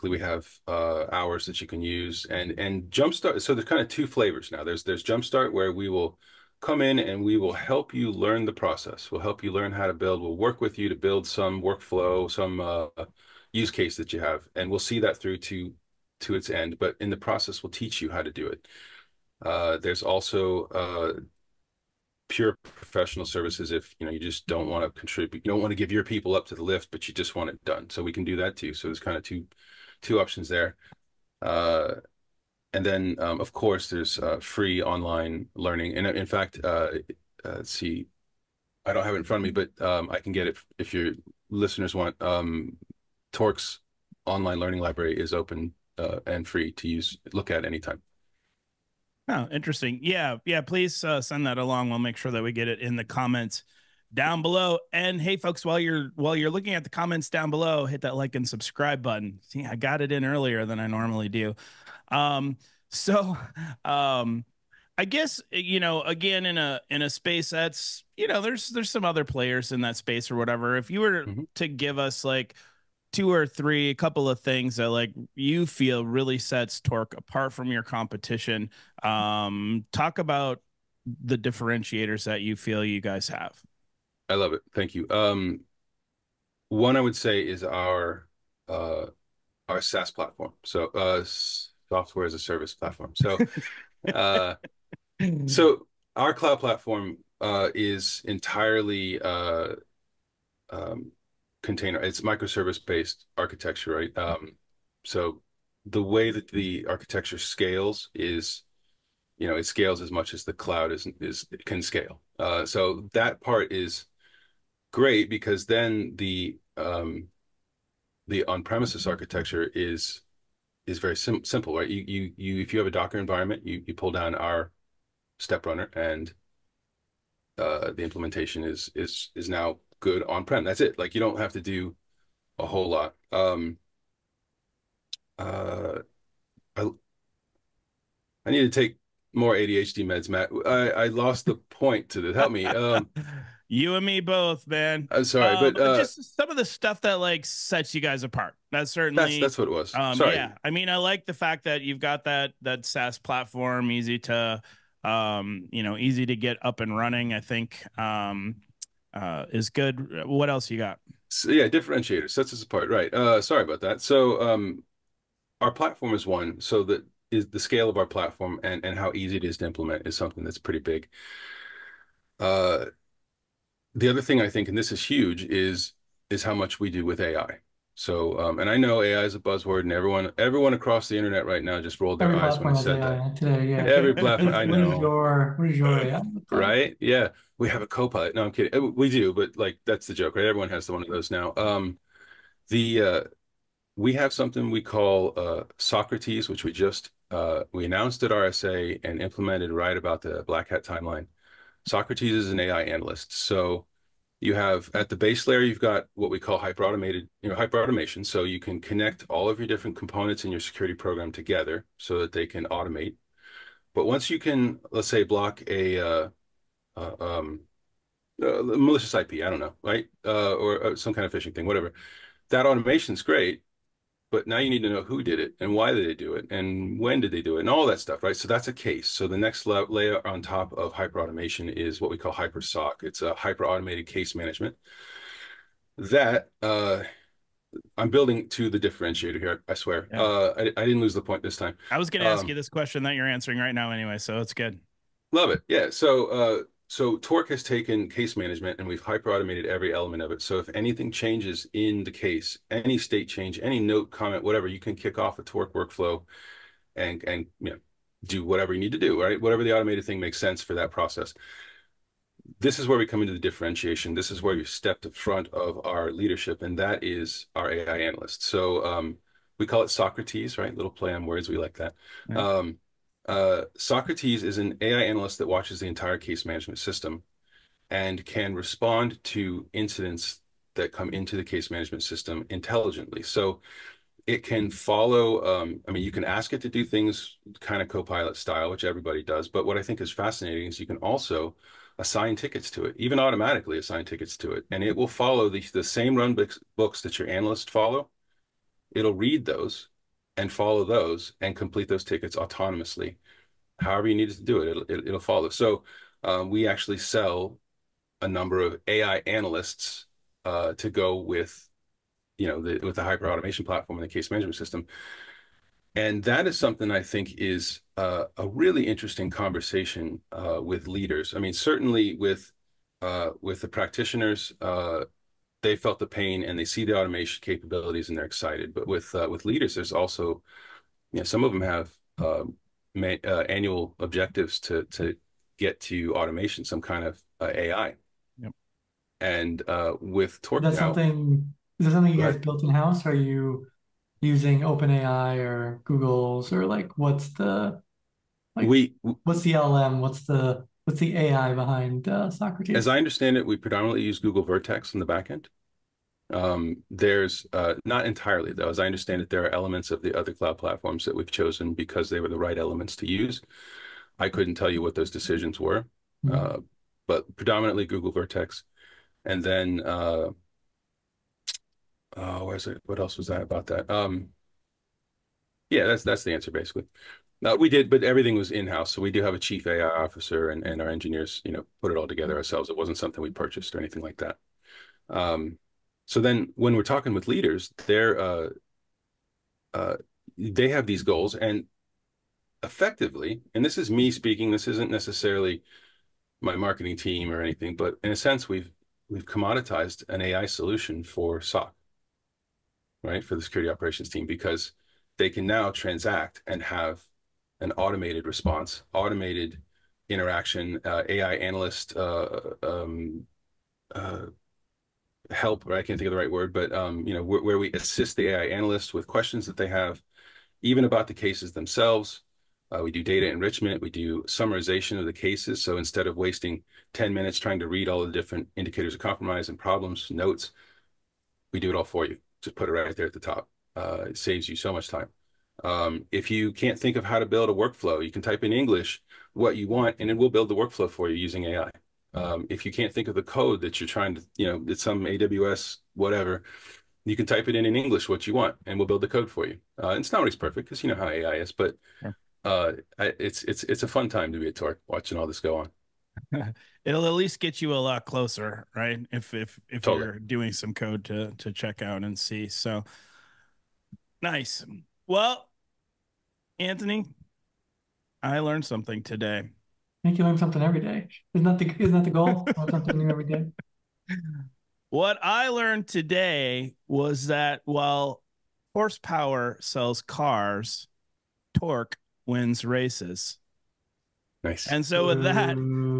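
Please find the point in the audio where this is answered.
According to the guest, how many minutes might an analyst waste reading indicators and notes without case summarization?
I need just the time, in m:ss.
7:06.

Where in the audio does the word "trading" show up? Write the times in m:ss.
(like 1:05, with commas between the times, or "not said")
not said.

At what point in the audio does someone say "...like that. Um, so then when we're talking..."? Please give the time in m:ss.
6:24.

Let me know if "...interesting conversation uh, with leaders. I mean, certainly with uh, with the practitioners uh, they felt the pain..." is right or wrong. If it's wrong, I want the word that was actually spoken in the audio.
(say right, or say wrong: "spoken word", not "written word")
right.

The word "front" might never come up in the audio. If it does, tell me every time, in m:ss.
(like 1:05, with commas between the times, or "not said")
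0:39, 4:25.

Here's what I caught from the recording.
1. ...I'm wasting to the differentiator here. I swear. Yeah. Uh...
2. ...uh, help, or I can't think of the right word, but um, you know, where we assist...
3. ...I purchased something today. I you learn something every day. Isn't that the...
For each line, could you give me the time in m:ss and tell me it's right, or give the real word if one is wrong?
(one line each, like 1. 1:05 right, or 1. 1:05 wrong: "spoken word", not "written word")
1. 3:57 wrong: "building", not "wasting"
2. 6:53 right
3. 7:48 wrong: "learned", not "purchased".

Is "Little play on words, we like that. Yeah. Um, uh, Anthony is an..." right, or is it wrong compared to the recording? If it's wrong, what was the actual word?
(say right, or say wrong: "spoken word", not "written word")
wrong: "Socrates", not "Anthony".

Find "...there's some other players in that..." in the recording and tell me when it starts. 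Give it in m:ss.
1:08.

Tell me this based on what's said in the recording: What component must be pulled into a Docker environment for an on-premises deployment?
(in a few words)
step runner.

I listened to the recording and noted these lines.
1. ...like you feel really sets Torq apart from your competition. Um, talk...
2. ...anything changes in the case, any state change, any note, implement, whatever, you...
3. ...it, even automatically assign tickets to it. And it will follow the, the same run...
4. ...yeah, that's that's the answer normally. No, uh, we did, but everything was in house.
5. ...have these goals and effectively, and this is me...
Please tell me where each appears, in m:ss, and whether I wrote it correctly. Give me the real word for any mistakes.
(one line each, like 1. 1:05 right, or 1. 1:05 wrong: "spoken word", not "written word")
1. 1:14 right
2. 4:10 wrong: "comment", not "implement"
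3. 4:52 right
4. 6:15 wrong: "basically", not "normally"
5. 6:30 right.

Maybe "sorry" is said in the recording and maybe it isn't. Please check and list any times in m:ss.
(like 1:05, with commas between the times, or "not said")
2:25, 2:30, 2:43.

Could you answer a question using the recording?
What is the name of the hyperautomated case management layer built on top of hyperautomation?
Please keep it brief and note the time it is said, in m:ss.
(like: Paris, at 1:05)
HyperSOC, at 3:52.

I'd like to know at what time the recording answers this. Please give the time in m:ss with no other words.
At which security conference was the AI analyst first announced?
3:18.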